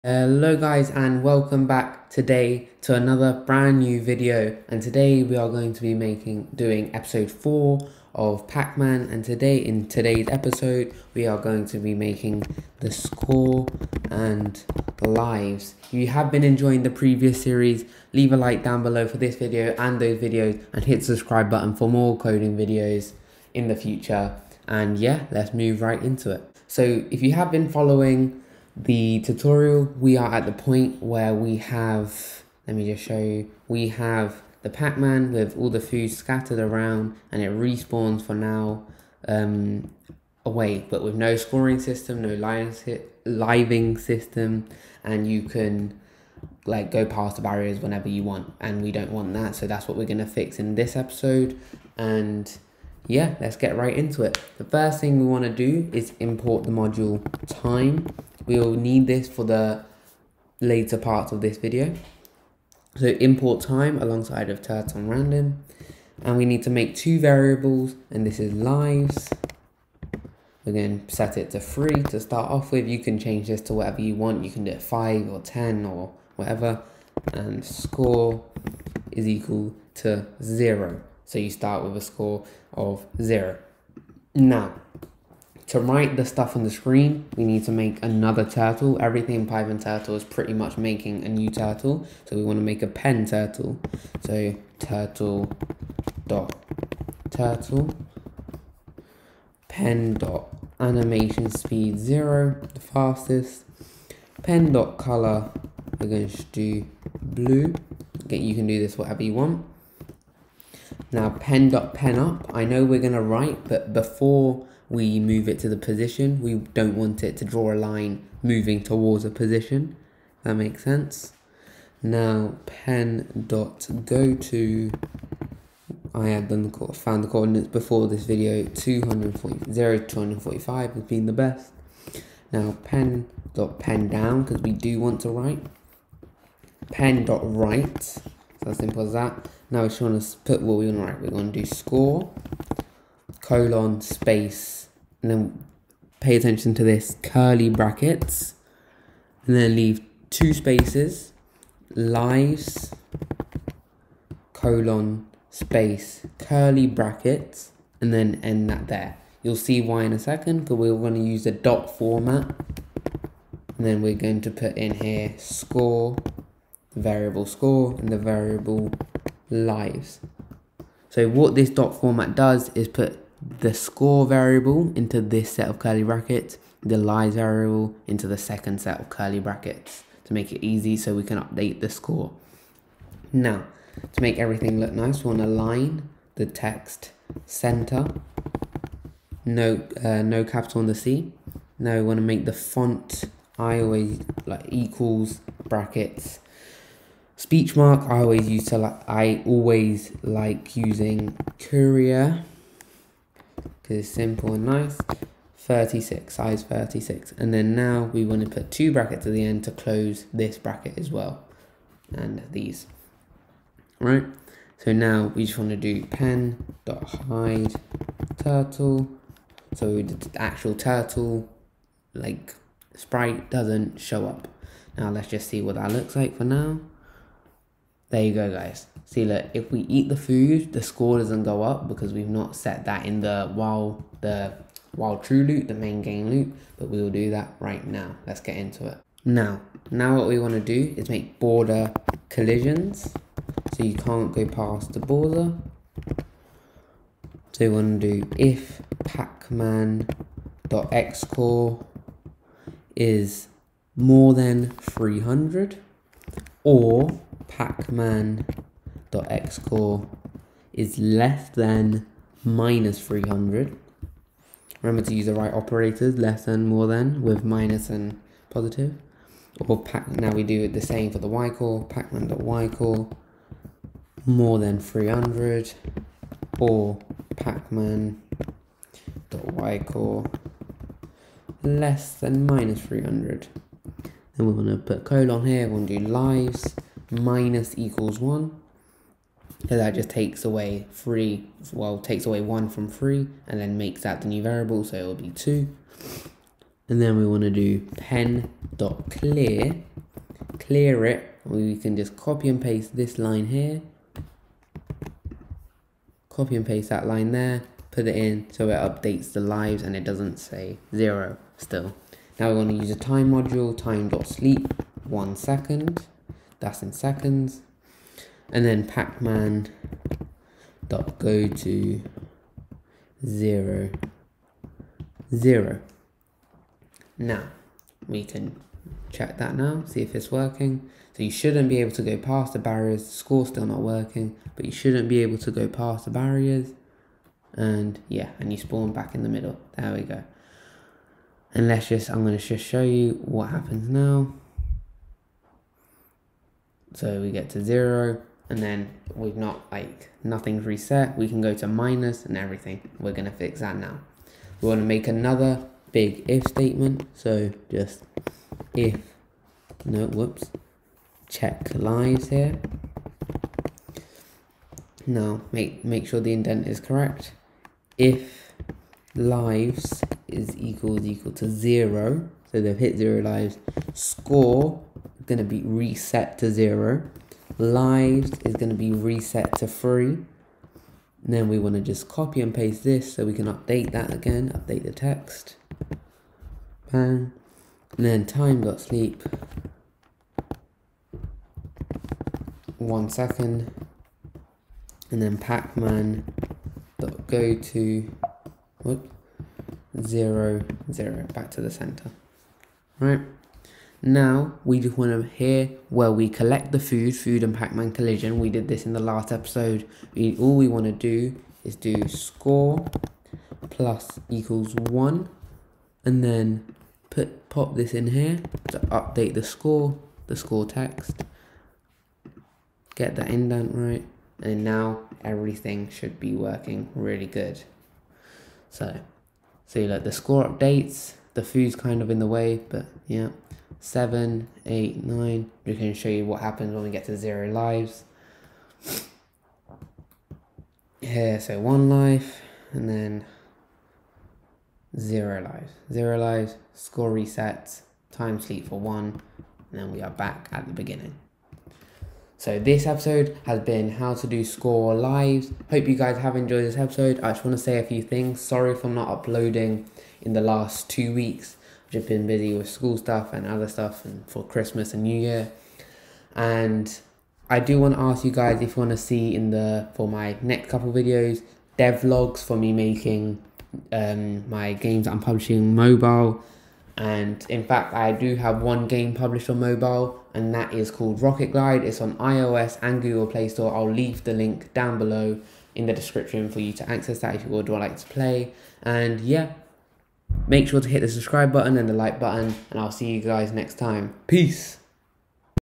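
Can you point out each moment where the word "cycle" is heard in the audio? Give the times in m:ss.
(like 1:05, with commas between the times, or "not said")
not said.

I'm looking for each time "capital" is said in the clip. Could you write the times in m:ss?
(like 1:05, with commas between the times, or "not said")
3:10.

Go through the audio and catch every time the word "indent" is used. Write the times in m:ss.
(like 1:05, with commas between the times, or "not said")
6:06, 7:03.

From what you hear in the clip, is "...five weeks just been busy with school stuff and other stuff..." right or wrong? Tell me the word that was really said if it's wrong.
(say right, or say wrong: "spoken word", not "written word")
wrong: "two", not "five".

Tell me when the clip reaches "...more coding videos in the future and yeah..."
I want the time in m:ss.
0:21.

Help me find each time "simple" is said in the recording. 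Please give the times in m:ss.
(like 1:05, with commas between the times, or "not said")
2:18, 3:24.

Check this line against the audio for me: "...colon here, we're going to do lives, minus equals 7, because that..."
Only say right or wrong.
wrong.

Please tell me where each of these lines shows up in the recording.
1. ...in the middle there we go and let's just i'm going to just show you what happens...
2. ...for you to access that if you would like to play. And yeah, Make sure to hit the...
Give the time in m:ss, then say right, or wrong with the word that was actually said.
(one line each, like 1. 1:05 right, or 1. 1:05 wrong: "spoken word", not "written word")
1. 5:39 right
2. 8:06 right.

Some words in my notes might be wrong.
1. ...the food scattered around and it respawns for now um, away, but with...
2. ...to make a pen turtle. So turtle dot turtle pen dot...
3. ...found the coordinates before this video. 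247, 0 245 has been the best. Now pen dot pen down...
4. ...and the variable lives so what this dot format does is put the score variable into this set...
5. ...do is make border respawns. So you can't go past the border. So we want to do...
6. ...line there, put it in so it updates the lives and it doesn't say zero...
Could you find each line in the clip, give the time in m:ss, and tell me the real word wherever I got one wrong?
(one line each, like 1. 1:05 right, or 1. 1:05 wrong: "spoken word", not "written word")
1. 0:35 right
2. 1:32 right
3. 2:06 wrong: "240", not "247"
4. 2:47 right
5. 4:00 wrong: "collisions", not "respawns"
6. 5:07 right.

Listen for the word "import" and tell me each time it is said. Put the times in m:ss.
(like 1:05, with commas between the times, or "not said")
0:56, 1:03.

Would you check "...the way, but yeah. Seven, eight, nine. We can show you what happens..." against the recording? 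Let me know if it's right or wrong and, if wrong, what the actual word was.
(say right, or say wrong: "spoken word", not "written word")
right.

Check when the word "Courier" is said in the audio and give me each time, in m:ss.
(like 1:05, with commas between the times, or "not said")
3:21.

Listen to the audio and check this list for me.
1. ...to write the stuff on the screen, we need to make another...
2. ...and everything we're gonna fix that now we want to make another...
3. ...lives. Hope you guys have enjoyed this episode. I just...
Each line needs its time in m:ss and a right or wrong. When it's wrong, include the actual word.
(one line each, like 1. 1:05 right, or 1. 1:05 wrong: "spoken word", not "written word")
1. 1:25 right
2. 5:52 right
3. 7:34 right.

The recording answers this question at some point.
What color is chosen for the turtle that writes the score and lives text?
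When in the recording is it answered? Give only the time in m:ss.
1:47.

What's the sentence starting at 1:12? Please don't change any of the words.
You can change this to whatever you want.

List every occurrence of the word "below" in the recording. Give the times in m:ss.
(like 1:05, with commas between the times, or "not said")
0:18, 8:04.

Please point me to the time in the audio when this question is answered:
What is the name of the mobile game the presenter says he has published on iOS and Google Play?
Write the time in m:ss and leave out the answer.
8:01.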